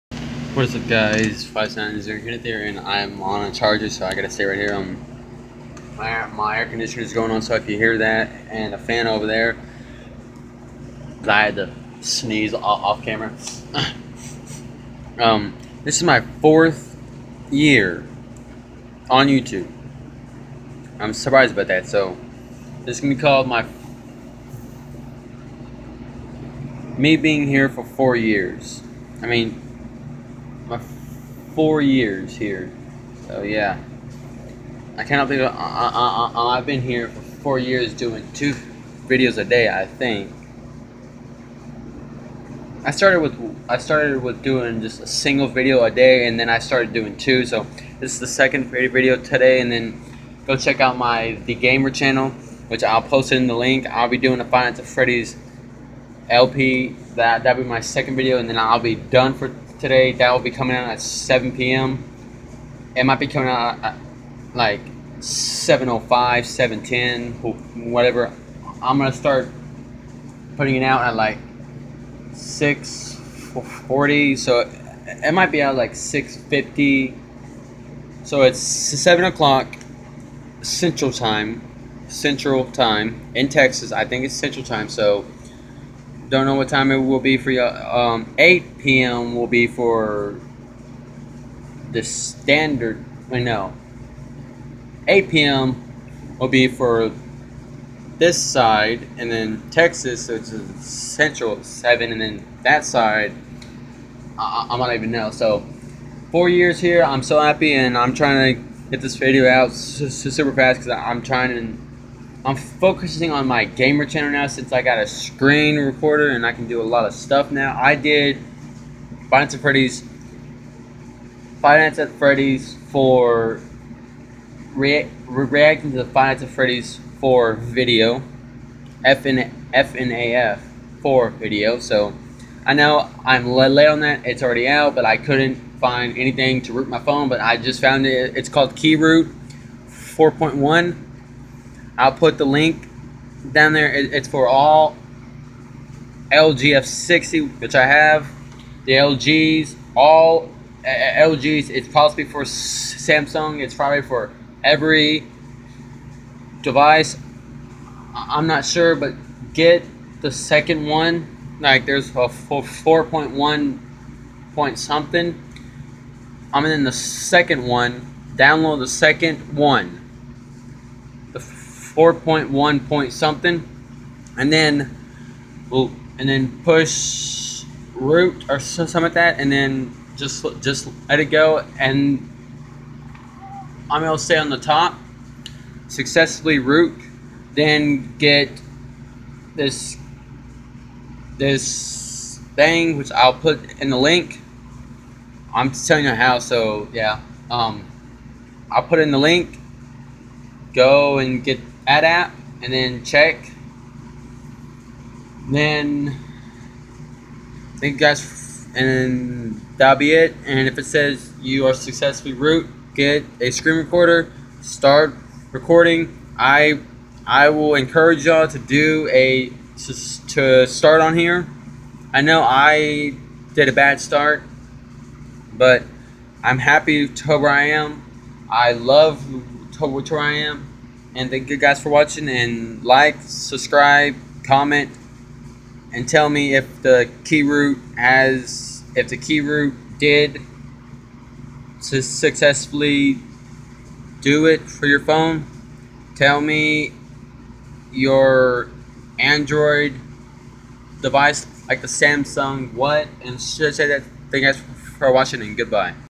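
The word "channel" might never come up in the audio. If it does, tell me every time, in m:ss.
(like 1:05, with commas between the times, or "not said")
0:51, 1:54.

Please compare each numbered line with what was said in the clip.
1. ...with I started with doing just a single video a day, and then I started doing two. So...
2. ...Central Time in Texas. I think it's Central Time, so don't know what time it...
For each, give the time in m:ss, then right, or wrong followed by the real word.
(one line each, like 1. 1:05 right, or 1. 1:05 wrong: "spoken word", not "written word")
1. 0:43 right
2. 1:22 right.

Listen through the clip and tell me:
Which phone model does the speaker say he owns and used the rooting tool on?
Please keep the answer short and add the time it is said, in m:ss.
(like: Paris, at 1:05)
LG F60, at 2:26.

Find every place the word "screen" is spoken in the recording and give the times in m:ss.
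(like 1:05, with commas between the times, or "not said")
1:55, 3:33.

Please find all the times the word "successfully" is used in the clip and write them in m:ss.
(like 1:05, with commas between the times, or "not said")
3:05, 3:31, 4:02.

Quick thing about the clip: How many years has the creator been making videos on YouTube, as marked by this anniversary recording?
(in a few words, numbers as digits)
4.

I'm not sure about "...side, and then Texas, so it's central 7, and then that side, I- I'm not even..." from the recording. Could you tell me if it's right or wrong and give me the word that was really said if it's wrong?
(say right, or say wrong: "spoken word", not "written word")
right.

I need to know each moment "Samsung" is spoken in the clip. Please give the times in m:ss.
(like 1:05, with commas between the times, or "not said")
2:32, 4:11.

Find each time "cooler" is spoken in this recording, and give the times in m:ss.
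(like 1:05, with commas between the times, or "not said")
not said.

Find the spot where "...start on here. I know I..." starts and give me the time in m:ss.
3:40.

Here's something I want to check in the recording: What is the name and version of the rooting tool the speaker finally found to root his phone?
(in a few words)
KingRoot 4.1.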